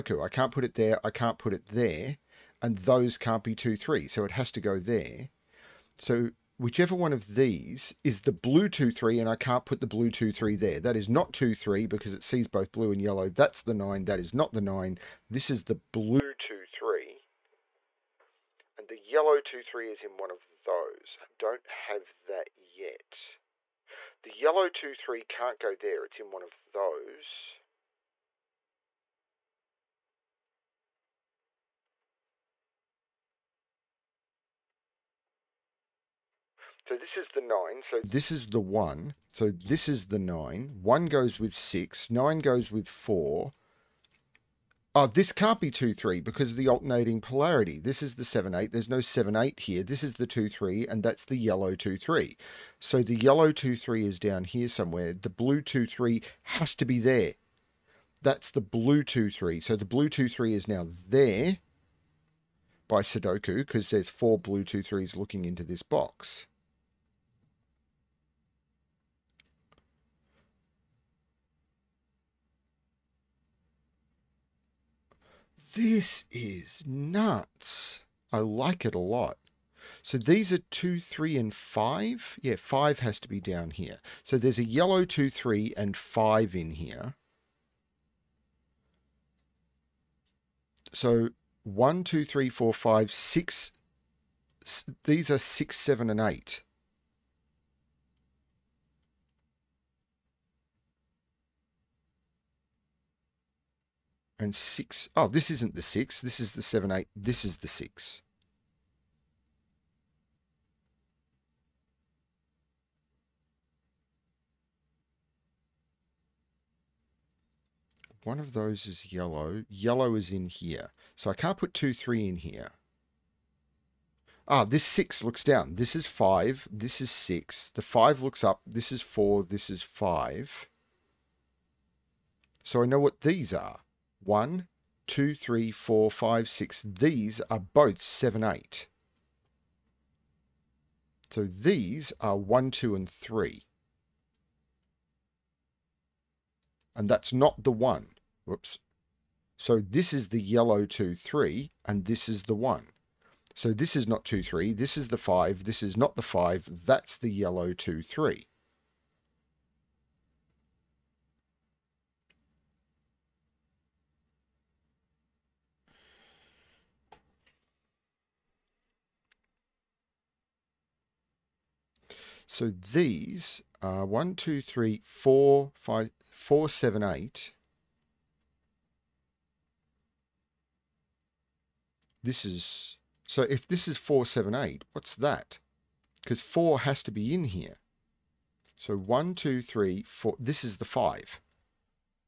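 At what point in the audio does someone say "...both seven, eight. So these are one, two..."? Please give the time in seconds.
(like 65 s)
137 s.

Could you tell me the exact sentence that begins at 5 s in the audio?
So whichever one of these is the blue 2, 3, and I can't put the blue 2, 3 there.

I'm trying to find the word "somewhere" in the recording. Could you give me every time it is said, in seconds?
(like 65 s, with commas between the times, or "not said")
54 s.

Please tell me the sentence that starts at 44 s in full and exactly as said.
Oh, this can't be 2, 3 because of the alternating polarity.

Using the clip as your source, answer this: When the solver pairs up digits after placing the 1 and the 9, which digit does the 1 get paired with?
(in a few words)
6.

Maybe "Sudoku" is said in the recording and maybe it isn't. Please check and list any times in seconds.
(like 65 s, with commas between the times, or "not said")
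63 s.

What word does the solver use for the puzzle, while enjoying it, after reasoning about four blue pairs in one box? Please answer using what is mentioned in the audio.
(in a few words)
Nuts.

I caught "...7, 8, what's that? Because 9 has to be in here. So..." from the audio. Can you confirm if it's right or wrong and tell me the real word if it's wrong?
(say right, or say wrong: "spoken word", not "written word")
wrong: "4", not "9".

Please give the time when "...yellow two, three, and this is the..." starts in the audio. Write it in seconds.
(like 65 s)
150 s.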